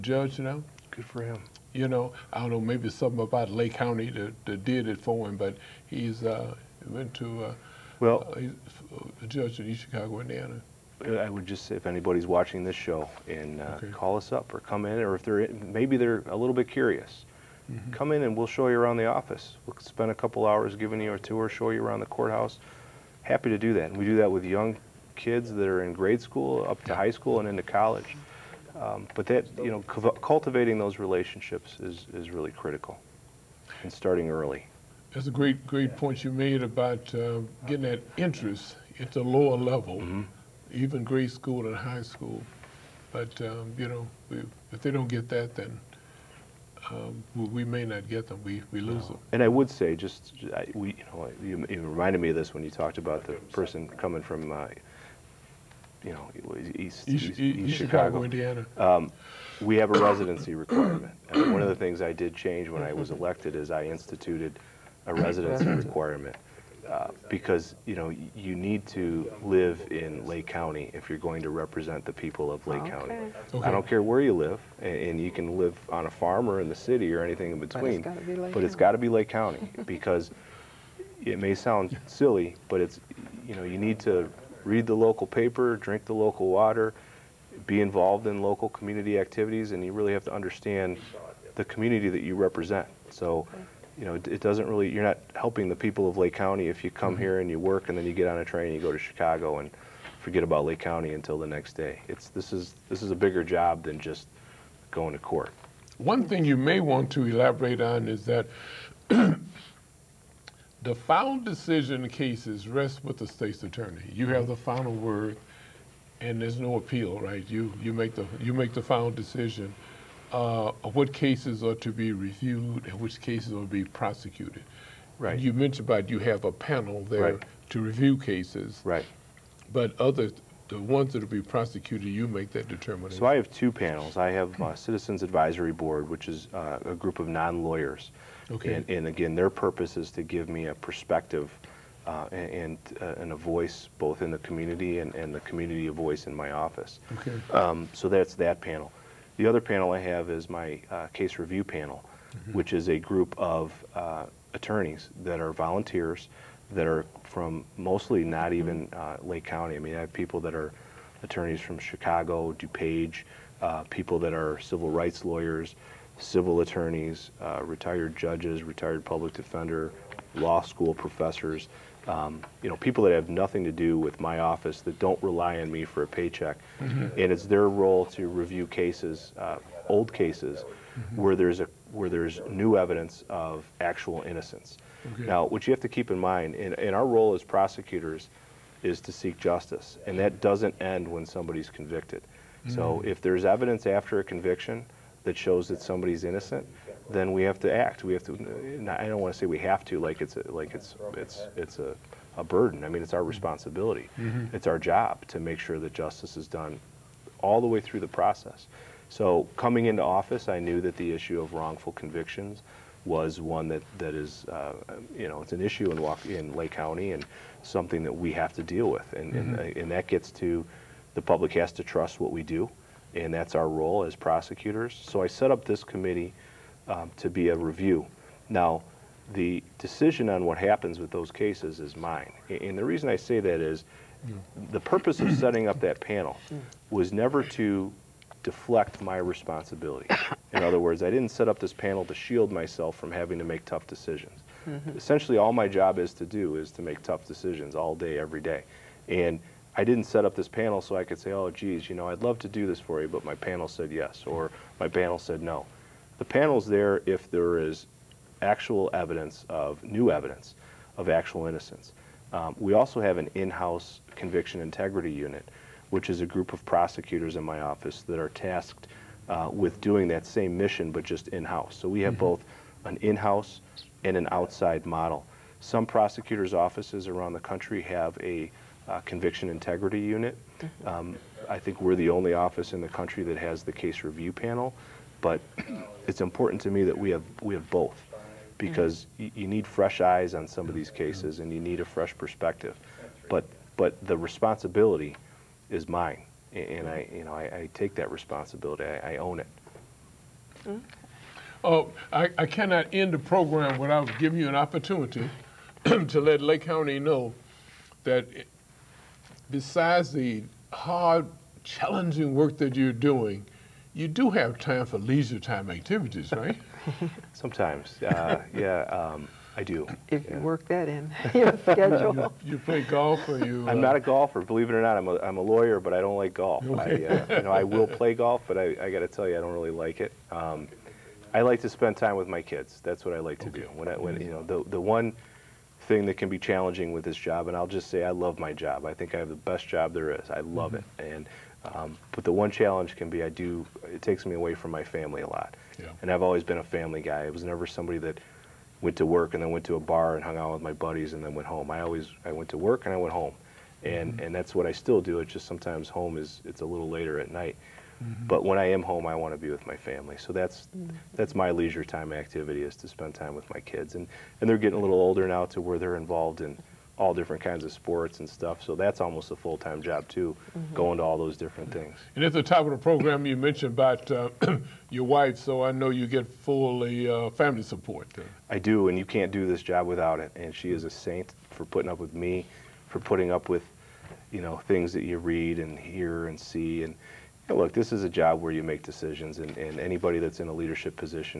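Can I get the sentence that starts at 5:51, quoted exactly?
I always, I went to work and I went home.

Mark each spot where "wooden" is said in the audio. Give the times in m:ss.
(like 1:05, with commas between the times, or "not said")
not said.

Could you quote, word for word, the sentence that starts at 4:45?
But it's important to me that we have we have both, because mm-hmm.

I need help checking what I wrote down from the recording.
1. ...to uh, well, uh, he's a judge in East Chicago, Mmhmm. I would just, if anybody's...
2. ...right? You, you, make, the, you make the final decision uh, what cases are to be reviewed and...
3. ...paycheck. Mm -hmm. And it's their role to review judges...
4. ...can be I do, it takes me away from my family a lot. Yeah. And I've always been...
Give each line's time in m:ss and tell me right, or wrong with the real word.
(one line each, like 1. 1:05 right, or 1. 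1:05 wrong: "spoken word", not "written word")
1. 0:07 wrong: "Indiana", not "Mmhmm"
2. 1:57 right
3. 2:56 wrong: "cases", not "judges"
4. 5:42 right.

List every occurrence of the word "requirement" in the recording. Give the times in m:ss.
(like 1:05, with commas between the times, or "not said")
1:00, 1:05.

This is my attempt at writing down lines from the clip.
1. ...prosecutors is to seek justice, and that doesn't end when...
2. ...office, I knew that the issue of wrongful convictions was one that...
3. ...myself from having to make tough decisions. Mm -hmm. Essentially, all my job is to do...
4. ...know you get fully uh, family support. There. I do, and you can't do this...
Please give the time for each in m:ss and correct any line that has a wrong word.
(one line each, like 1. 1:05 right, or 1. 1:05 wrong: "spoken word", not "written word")
1. 3:07 right
2. 3:30 right
3. 4:02 right
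4. 6:15 right.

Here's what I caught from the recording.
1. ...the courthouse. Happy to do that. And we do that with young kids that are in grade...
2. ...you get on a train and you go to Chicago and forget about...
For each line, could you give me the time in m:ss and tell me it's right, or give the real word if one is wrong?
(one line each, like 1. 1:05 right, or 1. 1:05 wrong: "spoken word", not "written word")
1. 0:21 right
2. 1:38 right.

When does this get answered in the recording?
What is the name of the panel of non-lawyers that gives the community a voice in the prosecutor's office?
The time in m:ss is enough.
2:14.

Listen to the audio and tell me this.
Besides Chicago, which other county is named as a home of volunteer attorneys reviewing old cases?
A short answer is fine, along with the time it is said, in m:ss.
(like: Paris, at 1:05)
DuPage, at 2:42.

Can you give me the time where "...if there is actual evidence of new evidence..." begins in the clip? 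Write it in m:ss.
4:17.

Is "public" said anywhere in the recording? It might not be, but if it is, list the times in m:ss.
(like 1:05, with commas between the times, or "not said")
2:49, 3:41.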